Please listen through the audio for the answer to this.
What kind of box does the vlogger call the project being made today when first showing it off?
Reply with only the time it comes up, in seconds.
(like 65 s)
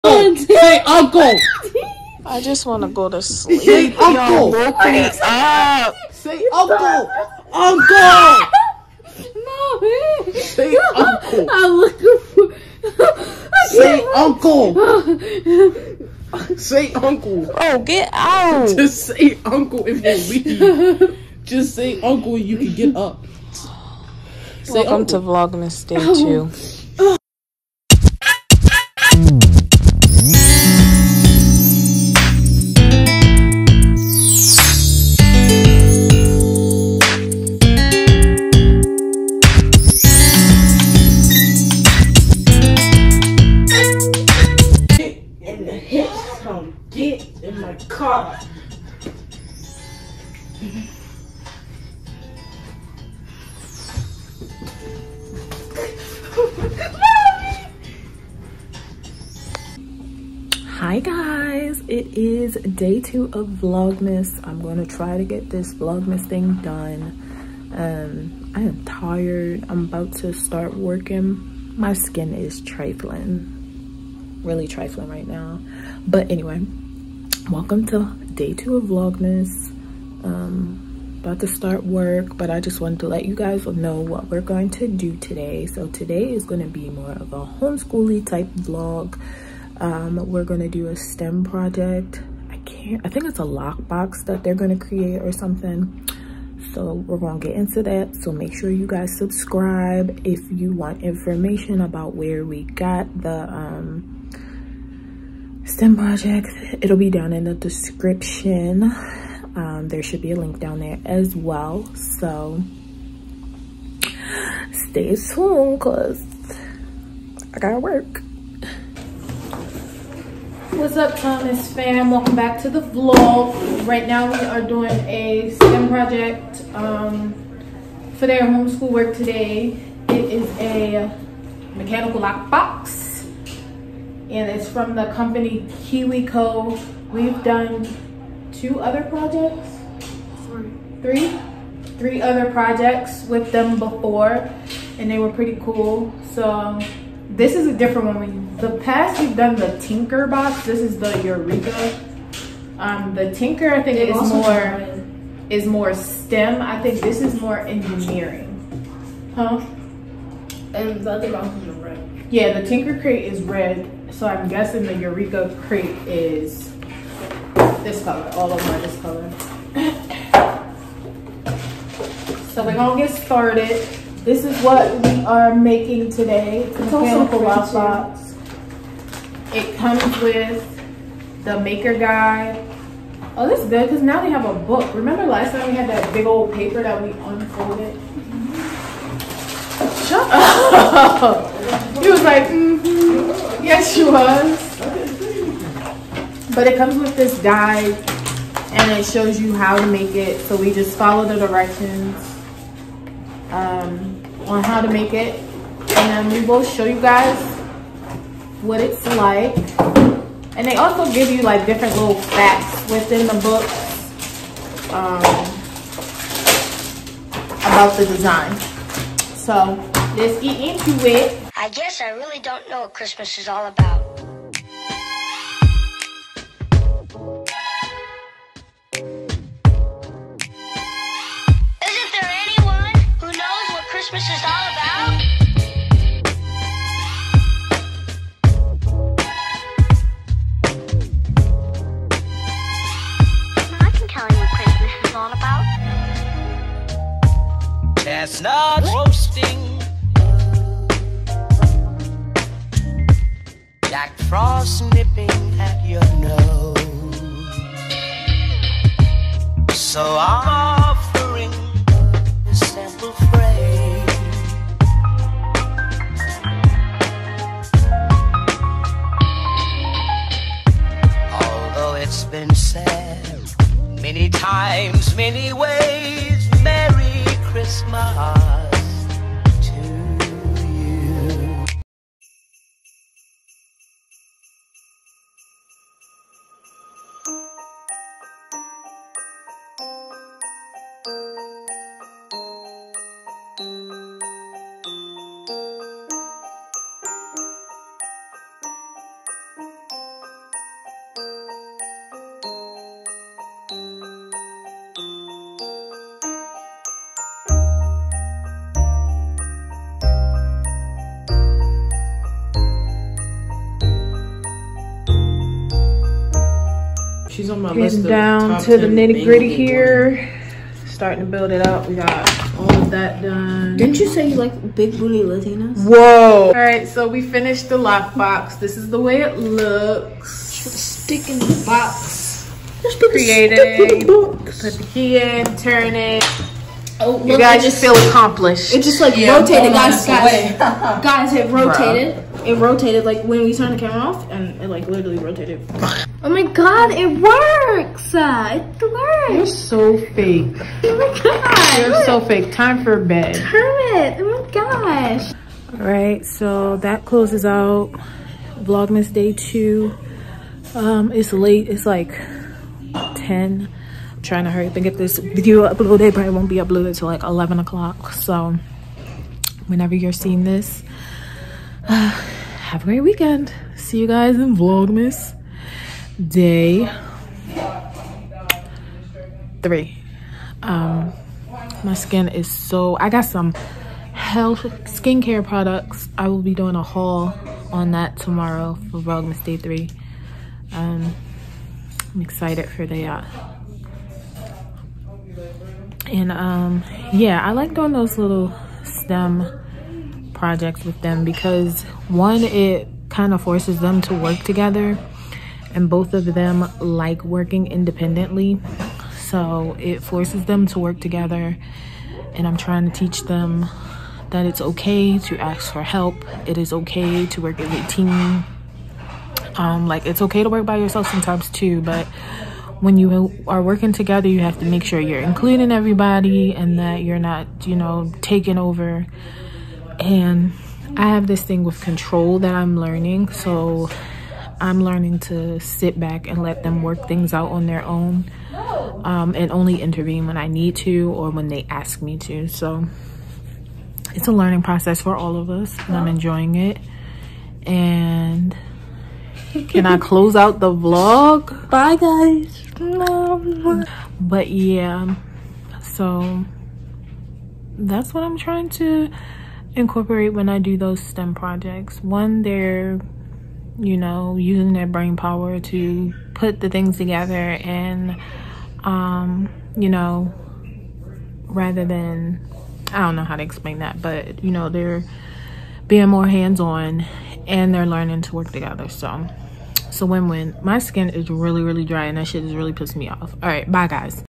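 176 s.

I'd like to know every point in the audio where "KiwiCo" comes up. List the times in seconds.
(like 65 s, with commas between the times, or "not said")
135 s.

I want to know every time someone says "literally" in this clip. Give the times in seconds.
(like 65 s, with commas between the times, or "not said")
344 s.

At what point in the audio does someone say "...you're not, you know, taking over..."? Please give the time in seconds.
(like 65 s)
427 s.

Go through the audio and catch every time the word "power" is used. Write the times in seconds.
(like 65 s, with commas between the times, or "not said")
465 s.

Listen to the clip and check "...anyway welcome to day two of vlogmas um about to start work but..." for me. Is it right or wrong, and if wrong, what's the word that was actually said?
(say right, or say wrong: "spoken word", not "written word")
right.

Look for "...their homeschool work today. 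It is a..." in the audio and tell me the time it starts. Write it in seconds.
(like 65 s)
128 s.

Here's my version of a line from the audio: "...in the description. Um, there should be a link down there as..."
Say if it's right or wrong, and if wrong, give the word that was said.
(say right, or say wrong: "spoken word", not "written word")
right.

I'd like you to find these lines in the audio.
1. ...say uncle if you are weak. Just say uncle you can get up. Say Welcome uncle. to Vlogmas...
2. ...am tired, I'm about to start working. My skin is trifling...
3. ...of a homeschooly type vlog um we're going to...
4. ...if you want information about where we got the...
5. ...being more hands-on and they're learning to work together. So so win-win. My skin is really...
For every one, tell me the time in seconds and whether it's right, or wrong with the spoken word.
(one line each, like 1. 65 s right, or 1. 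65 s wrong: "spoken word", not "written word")
1. 19 s right
2. 68 s right
3. 87 s right
4. 100 s right
5. 475 s right.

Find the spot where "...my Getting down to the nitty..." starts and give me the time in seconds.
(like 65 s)
317 s.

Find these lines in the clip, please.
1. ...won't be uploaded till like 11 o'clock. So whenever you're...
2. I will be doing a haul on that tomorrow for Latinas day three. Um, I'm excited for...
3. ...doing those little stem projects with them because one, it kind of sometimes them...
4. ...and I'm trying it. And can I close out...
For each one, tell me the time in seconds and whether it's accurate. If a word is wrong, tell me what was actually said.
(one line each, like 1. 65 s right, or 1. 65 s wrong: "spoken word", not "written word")
1. 366 s right
2. 386 s wrong: "Vlogmas", not "Latinas"
3. 397 s wrong: "forces", not "sometimes"
4. 445 s wrong: "enjoying", not "trying".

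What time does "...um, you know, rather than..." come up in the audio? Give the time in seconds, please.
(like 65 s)
468 s.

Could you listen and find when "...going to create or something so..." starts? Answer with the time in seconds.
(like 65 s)
94 s.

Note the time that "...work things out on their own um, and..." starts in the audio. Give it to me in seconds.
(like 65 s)
436 s.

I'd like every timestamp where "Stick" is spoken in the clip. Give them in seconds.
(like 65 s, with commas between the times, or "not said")
330 s.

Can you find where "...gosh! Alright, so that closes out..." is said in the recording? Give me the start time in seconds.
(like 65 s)
354 s.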